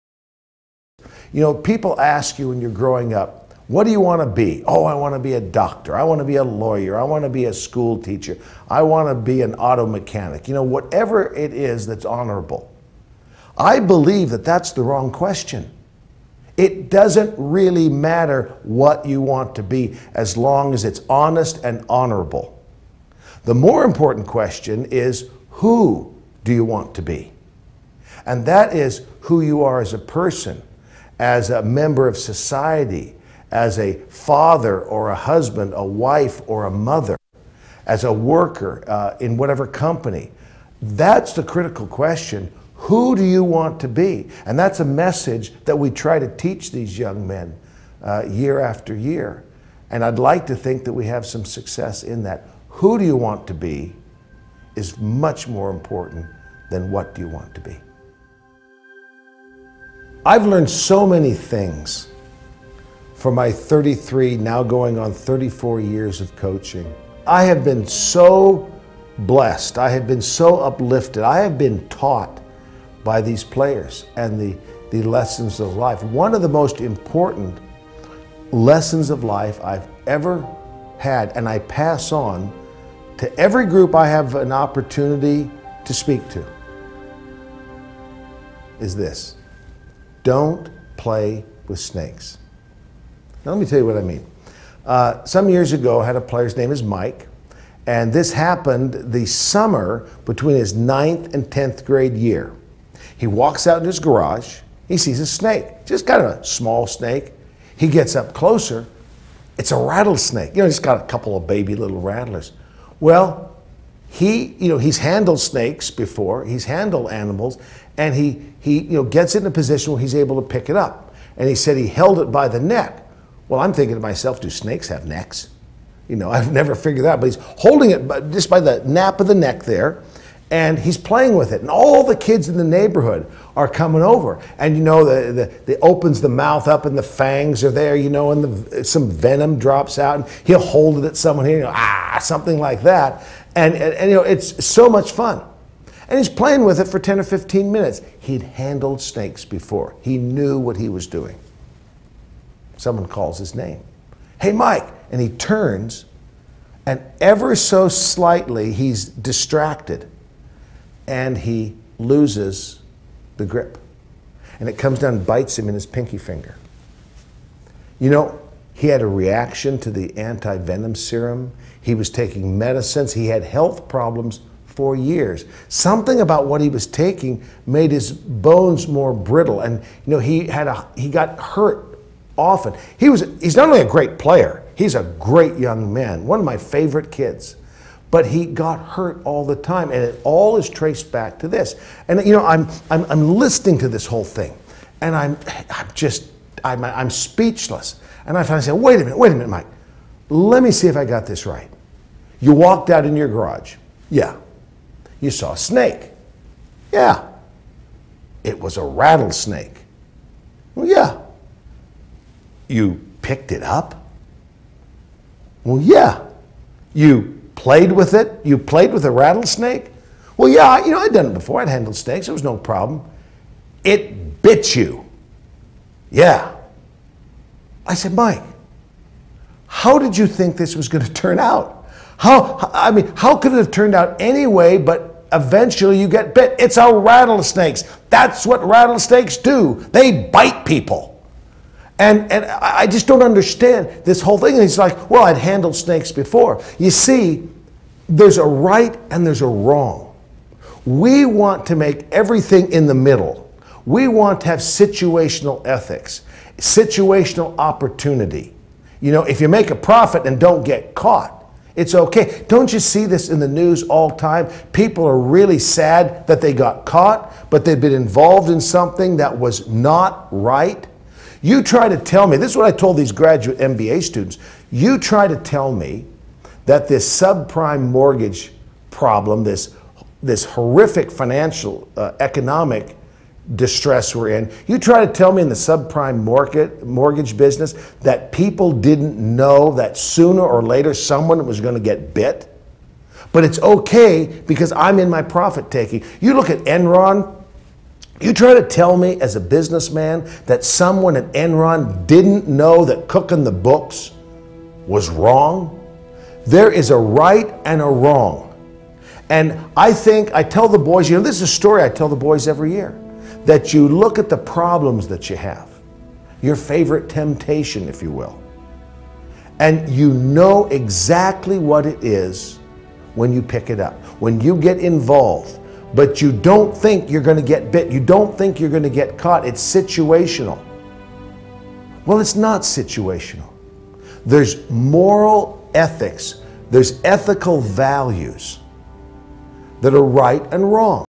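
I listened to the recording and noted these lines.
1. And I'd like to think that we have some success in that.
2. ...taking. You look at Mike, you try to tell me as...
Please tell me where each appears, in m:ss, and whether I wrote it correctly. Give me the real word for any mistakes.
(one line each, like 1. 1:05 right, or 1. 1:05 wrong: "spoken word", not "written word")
1. 0:49 right
2. 4:55 wrong: "Enron", not "Mike".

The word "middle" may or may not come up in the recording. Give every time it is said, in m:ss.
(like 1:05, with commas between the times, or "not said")
4:12.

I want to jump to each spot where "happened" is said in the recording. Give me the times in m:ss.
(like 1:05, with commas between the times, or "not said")
1:38.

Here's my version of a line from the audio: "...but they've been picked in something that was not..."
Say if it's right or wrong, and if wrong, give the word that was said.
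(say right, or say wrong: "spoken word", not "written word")
wrong: "involved", not "picked".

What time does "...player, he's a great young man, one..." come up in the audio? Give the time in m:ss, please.
3:04.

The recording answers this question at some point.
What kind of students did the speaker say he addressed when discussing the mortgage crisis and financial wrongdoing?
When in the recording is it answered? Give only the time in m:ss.
4:33.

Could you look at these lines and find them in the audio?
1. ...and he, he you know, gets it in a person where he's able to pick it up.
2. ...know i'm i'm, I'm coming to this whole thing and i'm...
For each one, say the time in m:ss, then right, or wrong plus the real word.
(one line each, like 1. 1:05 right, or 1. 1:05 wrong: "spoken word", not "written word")
1. 1:57 wrong: "position", not "person"
2. 3:12 wrong: "listening", not "coming".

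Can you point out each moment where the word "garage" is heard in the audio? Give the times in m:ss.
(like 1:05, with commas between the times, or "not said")
1:43, 3:23.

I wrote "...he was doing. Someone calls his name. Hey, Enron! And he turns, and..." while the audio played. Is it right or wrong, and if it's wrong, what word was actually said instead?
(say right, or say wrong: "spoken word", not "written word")
wrong: "Mike", not "Enron".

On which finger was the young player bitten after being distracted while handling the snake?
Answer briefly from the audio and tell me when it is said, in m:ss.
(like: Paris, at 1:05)
Pinky finger, at 2:45.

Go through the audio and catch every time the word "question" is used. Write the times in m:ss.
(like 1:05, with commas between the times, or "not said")
0:15, 0:24, 0:41.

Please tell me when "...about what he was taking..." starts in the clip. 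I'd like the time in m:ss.
2:56.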